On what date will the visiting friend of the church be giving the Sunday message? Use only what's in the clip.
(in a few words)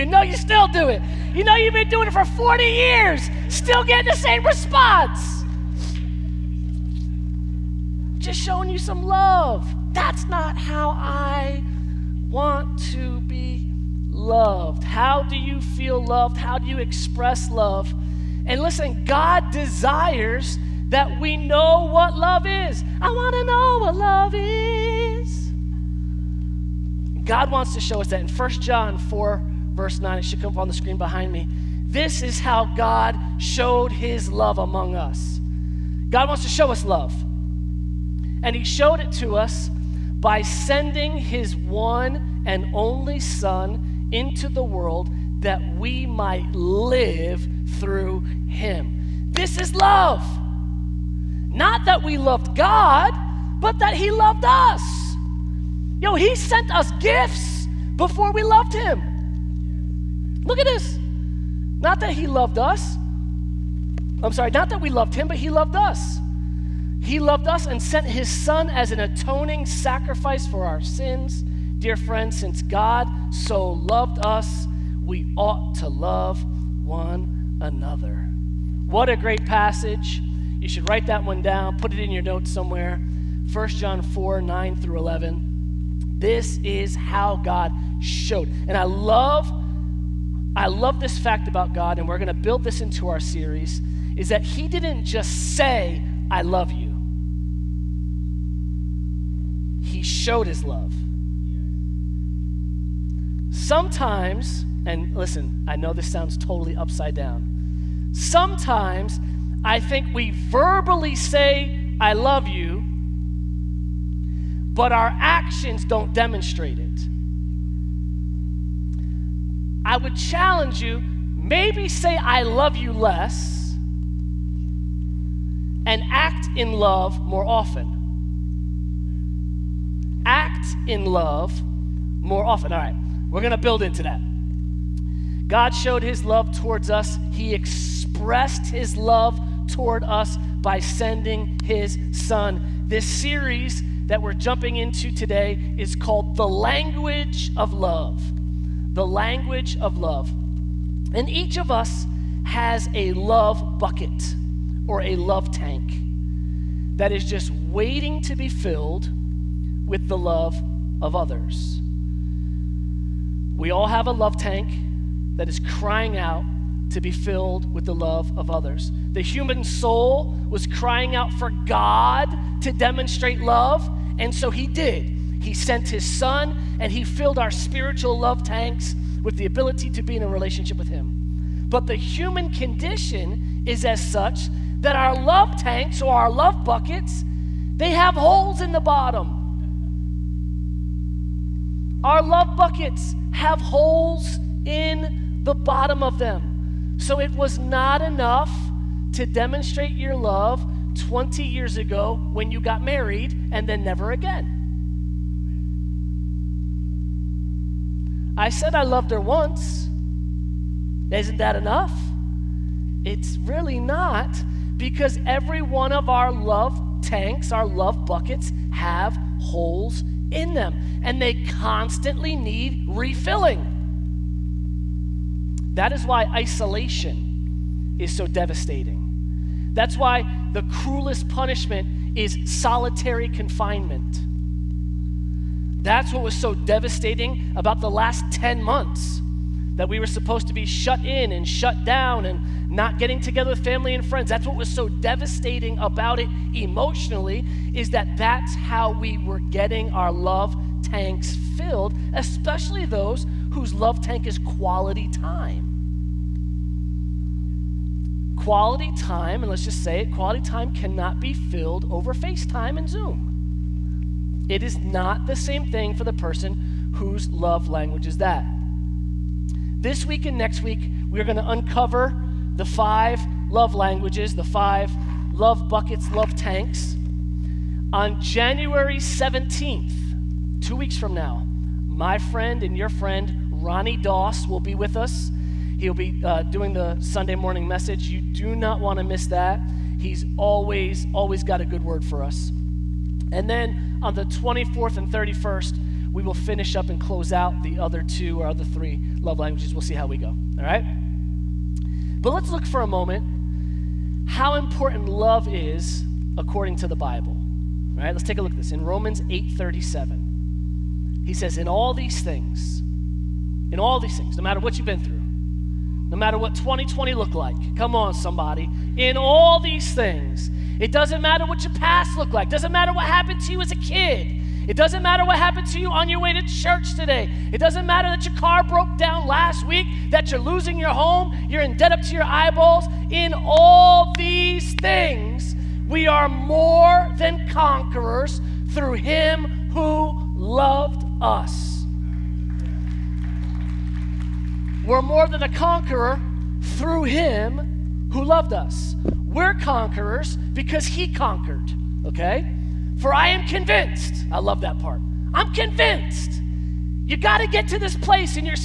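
January 17th.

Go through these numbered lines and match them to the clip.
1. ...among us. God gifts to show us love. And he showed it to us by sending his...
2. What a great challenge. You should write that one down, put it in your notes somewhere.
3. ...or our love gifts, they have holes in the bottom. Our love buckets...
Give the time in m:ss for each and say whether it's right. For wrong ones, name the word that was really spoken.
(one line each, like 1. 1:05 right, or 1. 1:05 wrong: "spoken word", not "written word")
1. 0:34 wrong: "wants", not "gifts"
2. 1:18 wrong: "passage", not "challenge"
3. 3:06 wrong: "buckets", not "gifts".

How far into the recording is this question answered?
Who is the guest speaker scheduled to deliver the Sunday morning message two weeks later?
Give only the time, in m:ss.
4:43.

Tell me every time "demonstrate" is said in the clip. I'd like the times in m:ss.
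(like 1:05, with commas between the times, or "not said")
1:56, 2:52, 3:19.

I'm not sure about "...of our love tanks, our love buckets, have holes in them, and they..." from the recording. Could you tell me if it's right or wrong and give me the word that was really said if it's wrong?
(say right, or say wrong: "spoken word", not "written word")
right.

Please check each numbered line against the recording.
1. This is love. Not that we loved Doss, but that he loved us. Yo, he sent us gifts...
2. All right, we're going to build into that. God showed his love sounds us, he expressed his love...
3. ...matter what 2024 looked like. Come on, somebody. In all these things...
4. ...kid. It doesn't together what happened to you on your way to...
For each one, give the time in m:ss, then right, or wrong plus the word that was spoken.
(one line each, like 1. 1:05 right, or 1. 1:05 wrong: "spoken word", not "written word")
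1. 0:49 wrong: "God", not "Doss"
2. 2:12 wrong: "towards", not "sounds"
3. 5:16 wrong: "2020", not "2024"
4. 5:23 wrong: "matter", not "together".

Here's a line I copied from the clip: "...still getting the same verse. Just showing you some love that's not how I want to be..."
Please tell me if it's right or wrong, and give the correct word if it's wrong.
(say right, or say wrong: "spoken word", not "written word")
wrong: "response", not "verse".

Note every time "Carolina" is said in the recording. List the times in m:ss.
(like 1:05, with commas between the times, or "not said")
not said.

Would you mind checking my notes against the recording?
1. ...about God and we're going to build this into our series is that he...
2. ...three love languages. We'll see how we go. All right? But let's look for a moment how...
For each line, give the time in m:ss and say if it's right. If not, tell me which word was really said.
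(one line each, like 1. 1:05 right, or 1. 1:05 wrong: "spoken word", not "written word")
1. 1:31 right
2. 4:58 right.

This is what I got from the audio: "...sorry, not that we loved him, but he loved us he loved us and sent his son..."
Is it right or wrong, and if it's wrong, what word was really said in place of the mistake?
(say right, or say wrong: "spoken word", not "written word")
right.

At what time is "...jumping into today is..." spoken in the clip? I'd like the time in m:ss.
2:24.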